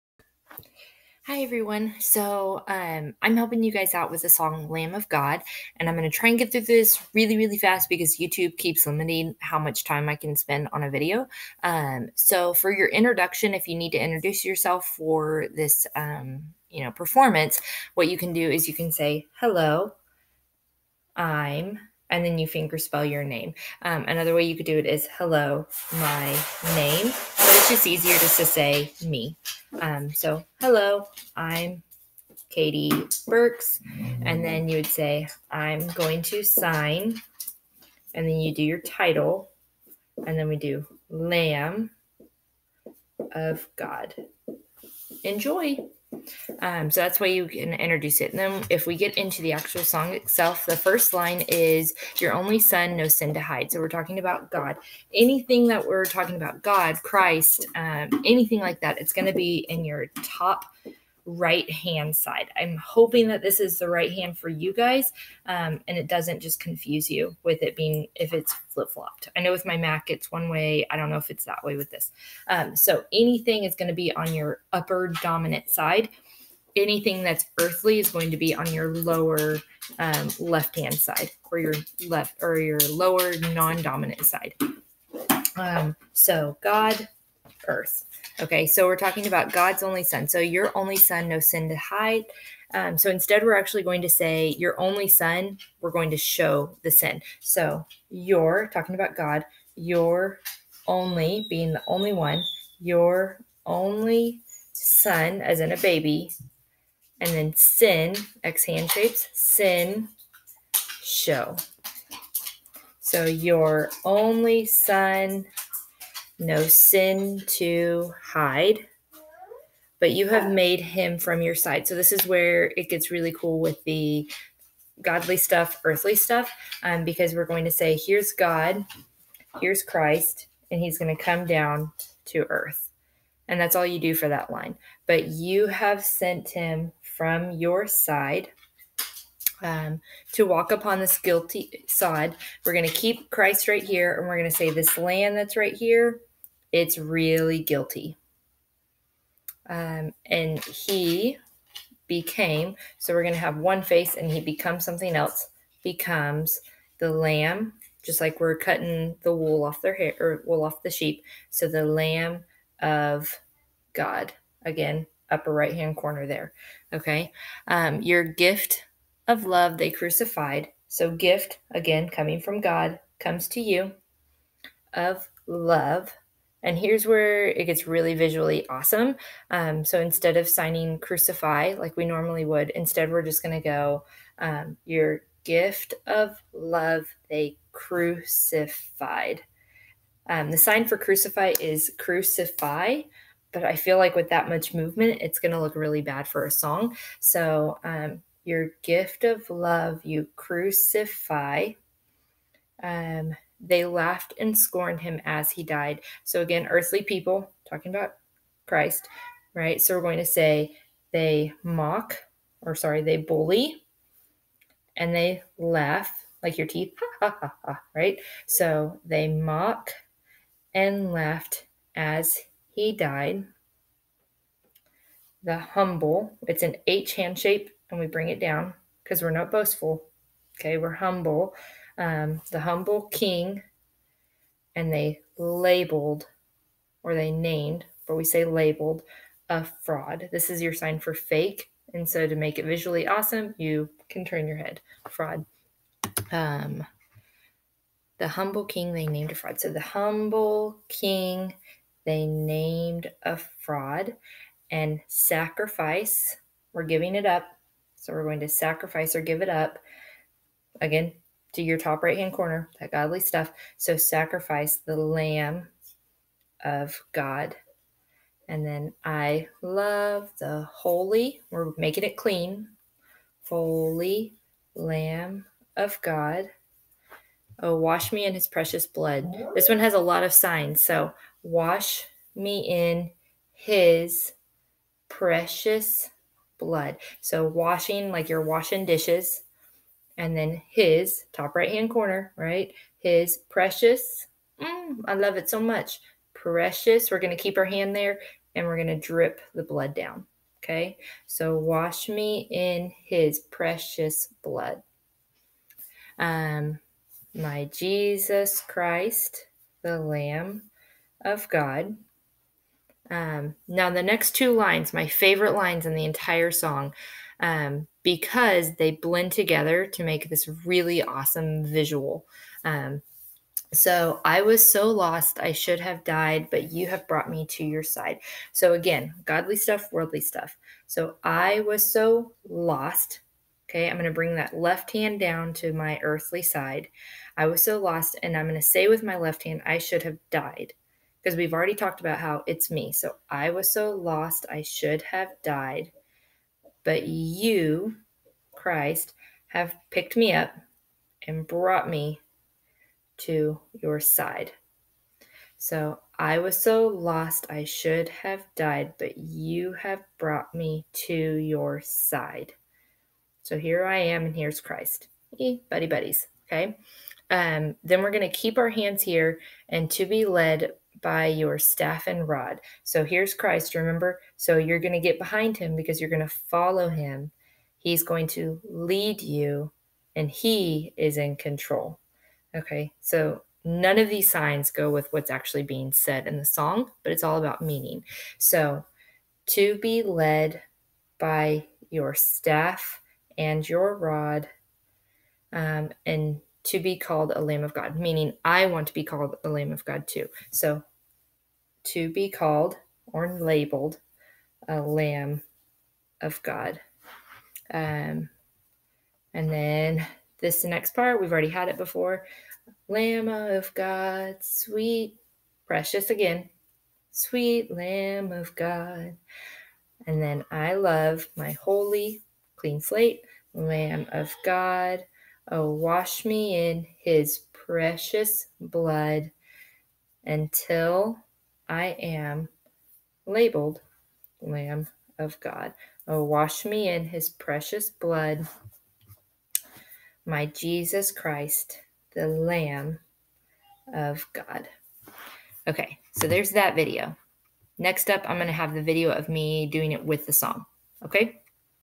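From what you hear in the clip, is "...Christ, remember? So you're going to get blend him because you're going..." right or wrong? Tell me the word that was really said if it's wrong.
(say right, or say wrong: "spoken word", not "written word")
wrong: "behind", not "blend".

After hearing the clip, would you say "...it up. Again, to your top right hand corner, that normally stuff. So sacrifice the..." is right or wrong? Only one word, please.
wrong.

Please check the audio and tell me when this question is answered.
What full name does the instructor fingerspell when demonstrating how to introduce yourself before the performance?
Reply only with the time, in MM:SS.
00:32.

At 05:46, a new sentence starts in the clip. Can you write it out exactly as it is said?
But you, Christ, have picked me up and brought me to your side.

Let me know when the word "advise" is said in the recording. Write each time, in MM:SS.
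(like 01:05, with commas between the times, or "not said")
not said.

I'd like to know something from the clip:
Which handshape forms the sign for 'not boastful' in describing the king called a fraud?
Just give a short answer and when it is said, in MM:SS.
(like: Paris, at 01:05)
H hand shape, at 03:46.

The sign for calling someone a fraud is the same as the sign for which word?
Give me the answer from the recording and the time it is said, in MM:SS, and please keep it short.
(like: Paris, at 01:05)
fake, at 04:01.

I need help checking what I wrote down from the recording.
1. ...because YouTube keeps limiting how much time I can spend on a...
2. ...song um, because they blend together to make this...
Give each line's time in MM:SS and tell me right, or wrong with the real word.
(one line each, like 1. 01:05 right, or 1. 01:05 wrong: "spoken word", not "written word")
1. 00:07 right
2. 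05:16 right.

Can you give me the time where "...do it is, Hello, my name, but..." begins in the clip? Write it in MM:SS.
00:24.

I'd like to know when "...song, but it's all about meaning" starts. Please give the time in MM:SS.
06:26.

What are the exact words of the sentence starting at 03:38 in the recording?
So, they mock and laughed as he died.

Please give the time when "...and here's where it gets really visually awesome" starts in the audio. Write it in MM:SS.
02:56.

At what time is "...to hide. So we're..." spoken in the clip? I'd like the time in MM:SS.
00:53.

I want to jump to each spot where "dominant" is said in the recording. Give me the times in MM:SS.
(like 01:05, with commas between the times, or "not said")
01:15, 01:23.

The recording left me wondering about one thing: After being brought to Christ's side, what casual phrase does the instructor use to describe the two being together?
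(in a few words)
buddy buddies.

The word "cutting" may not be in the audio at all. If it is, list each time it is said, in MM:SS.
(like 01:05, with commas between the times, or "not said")
02:38.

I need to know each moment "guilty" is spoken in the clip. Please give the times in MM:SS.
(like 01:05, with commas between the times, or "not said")
02:21, 02:27.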